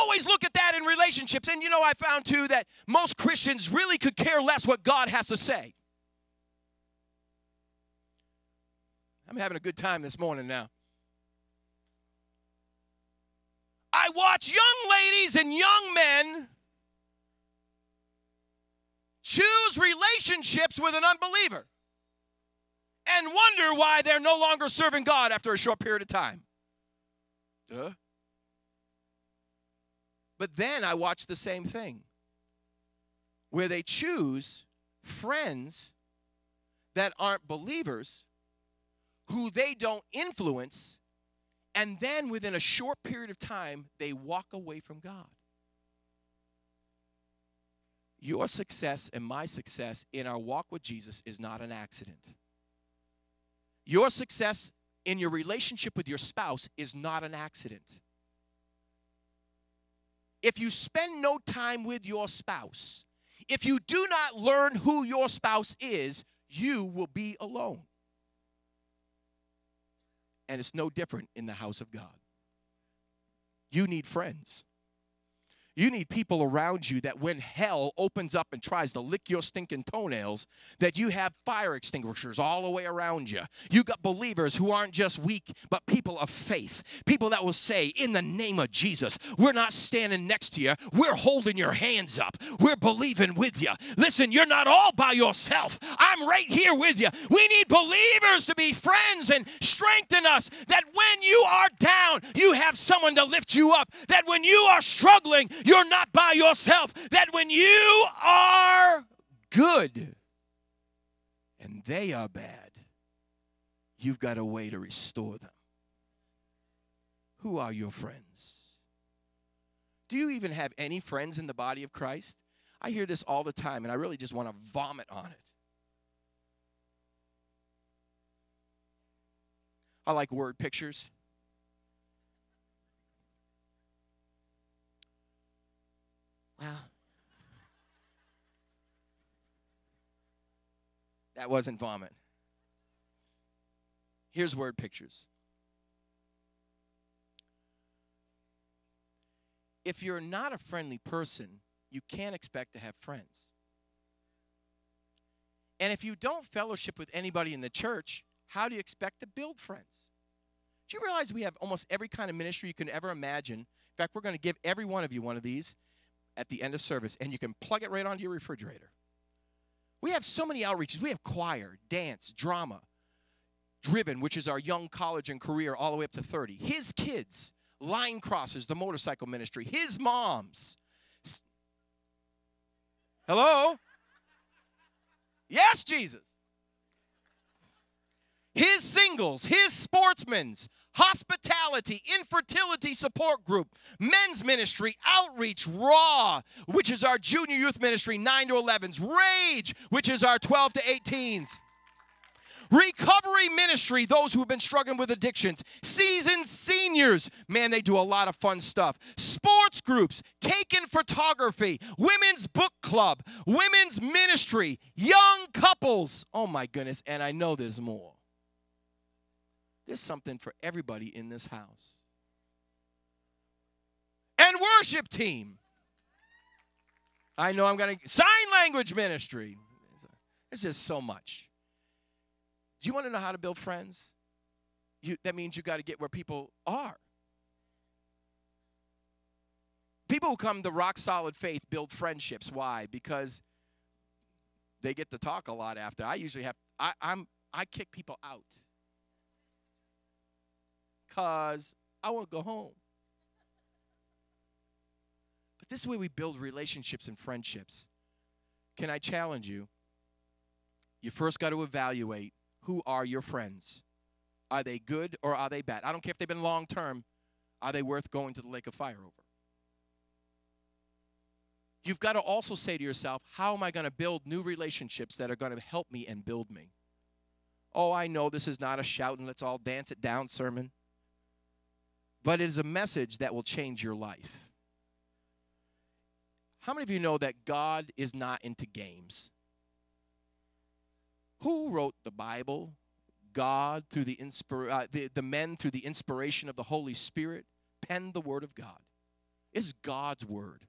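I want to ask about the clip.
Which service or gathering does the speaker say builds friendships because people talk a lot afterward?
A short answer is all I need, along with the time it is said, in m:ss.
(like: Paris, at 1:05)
Rock Solid Faith, at 4:00.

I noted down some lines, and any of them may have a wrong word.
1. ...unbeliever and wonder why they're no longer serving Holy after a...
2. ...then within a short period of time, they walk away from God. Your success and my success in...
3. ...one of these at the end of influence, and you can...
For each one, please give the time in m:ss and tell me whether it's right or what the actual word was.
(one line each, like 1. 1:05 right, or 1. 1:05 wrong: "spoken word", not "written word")
1. 0:21 wrong: "God", not "Holy"
2. 0:41 right
3. 2:45 wrong: "service", not "influence".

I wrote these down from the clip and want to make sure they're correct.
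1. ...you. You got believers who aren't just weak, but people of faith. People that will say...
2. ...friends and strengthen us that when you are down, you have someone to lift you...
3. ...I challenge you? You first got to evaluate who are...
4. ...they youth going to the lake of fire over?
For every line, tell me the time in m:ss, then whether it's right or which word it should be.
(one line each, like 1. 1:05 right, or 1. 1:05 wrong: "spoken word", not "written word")
1. 1:23 right
2. 1:38 right
3. 4:18 right
4. 4:27 wrong: "worth", not "youth".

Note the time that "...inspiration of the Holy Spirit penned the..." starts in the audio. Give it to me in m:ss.
4:55.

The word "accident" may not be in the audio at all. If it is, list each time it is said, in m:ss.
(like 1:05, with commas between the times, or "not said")
0:51, 0:57.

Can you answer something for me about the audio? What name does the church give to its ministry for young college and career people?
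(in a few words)
Driven.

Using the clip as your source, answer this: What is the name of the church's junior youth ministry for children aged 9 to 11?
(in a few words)
Raw.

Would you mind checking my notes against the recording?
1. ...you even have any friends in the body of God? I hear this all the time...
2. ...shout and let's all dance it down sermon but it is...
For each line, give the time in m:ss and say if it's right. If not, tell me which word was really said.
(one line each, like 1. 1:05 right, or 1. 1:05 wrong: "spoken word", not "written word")
1. 2:00 wrong: "Christ", not "God"
2. 4:38 right.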